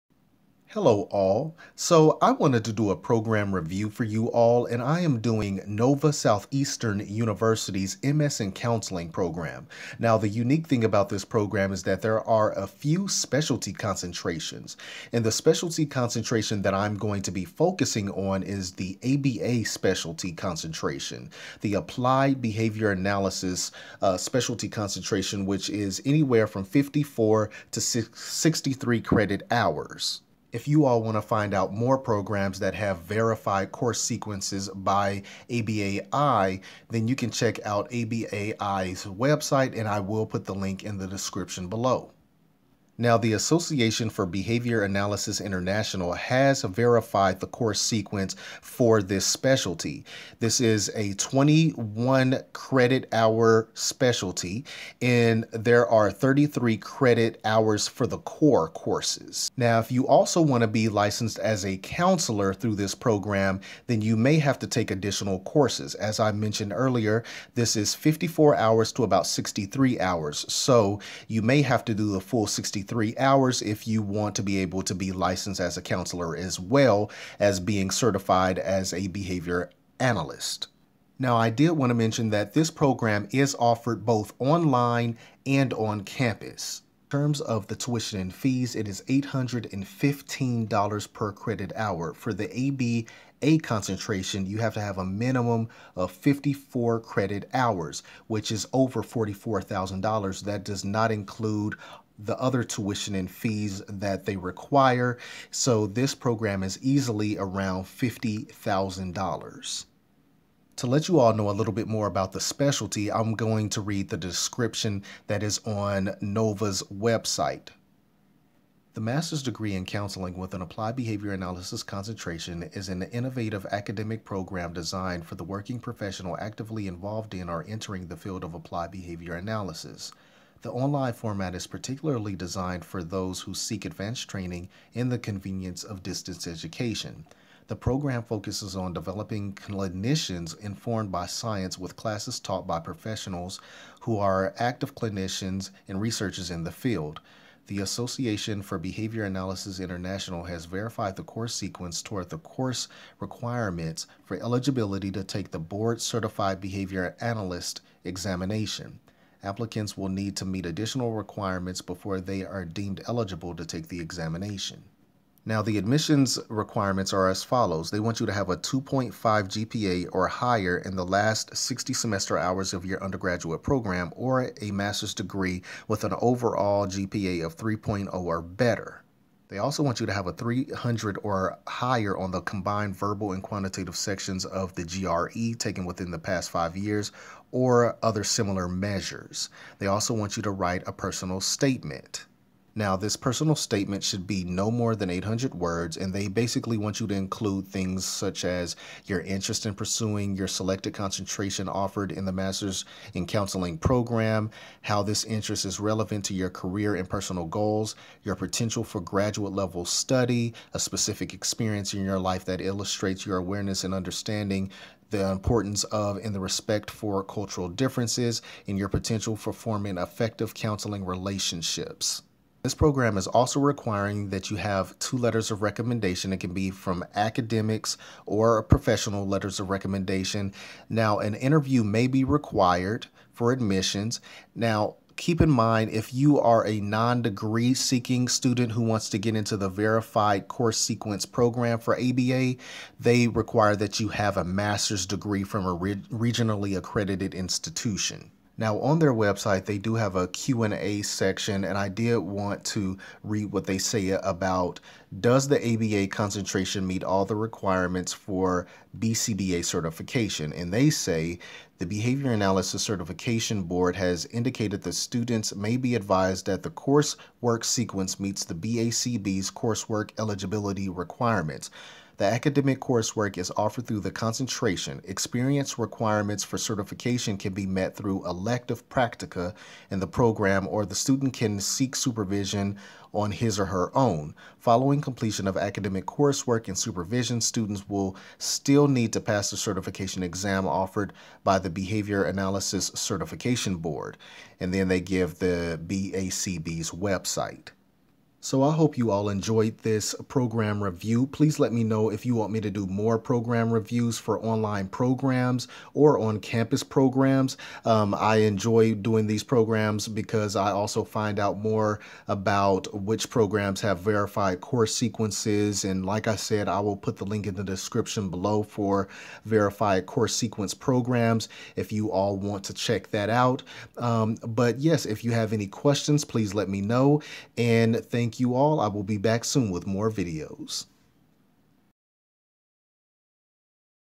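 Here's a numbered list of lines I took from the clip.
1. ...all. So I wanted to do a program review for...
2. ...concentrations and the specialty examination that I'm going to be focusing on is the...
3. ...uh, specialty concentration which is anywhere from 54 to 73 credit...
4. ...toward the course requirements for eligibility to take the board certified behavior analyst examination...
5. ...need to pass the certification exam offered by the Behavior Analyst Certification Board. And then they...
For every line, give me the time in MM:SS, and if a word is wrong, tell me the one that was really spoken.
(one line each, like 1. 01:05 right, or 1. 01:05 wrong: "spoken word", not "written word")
1. 00:01 right
2. 00:13 wrong: "concentration", not "examination"
3. 00:24 wrong: "63", not "73"
4. 02:32 right
5. 04:48 right.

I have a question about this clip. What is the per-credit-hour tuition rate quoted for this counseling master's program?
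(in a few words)
$815.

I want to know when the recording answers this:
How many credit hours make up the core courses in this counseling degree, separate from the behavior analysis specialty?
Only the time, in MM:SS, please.
00:56.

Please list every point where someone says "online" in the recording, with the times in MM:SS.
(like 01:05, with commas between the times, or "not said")
01:24, 02:10, 05:04.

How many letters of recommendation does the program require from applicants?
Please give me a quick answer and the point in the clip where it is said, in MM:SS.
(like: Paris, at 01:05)
2, at 03:44.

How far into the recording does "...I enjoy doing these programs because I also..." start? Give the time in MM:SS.
05:08.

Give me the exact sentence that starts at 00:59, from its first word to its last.
Now, if you also want to be licensed as a counselor through this program, then you may have to take additional courses.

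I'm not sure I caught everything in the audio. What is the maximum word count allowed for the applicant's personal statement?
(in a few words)
800 words.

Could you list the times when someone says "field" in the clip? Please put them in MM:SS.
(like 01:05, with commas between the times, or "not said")
02:08, 02:26.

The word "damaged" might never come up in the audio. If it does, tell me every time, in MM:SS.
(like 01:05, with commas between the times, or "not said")
not said.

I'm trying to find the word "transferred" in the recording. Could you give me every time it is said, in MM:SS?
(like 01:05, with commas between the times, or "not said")
not said.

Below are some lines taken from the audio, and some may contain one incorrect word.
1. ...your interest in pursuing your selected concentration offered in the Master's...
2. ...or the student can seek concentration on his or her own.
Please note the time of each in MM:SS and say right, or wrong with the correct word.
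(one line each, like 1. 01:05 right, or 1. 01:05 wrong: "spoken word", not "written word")
1. 03:19 right
2. 04:40 wrong: "supervision", not "concentration".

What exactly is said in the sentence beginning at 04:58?
So I hope you all enjoyed this program review.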